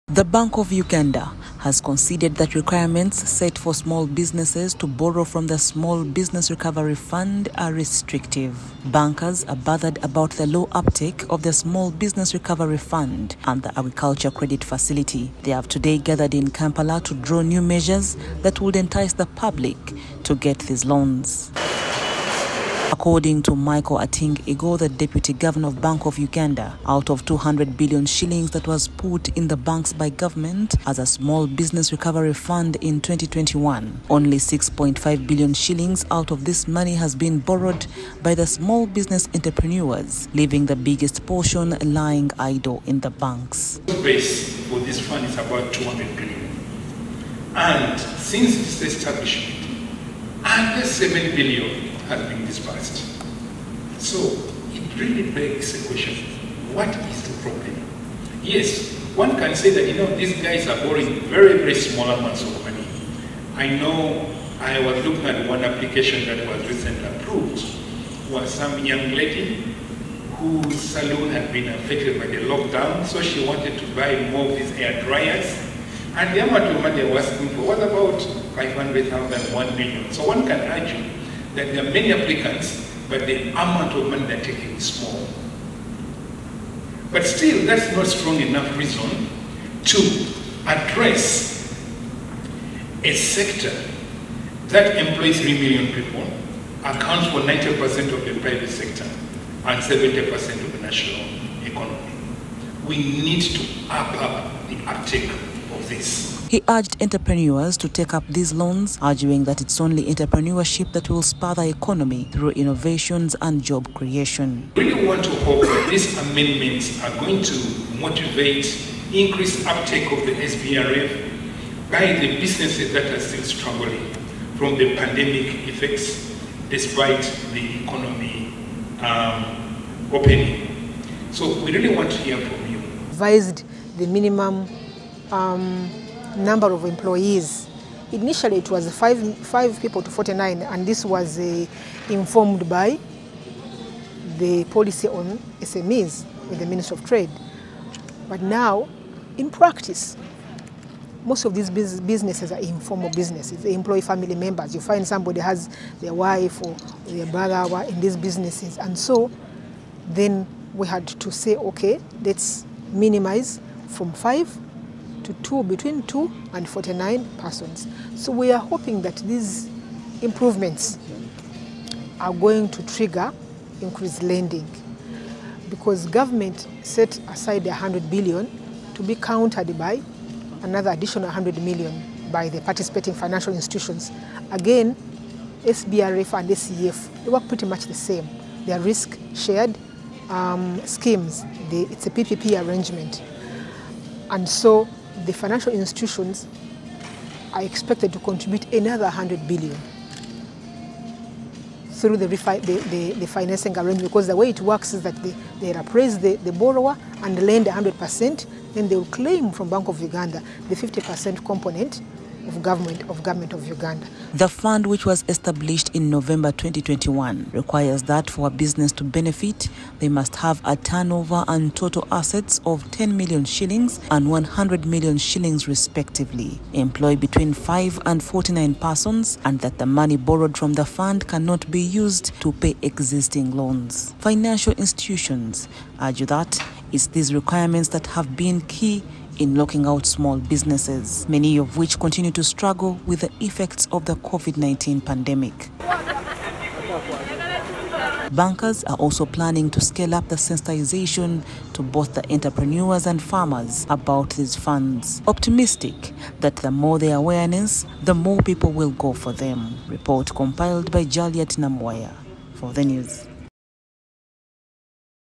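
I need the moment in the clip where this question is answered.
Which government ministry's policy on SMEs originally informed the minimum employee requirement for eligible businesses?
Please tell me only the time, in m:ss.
2:26.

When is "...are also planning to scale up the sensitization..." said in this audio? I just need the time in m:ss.
4:08.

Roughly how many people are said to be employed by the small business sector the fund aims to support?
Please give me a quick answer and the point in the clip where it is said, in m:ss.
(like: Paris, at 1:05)
3 million, at 1:35.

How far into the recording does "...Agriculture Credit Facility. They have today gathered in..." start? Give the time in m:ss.
0:13.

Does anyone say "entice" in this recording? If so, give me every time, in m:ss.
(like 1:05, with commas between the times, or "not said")
0:18.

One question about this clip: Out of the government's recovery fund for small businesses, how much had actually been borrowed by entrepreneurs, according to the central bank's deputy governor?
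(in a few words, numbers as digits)
6.5 billion shillings.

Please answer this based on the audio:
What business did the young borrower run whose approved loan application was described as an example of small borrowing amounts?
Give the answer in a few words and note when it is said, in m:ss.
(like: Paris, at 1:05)
Salon, at 1:10.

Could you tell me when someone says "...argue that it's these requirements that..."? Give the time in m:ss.
3:55.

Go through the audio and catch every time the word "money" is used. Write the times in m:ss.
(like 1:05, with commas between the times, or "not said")
0:36, 1:02, 1:16, 1:24, 3:49.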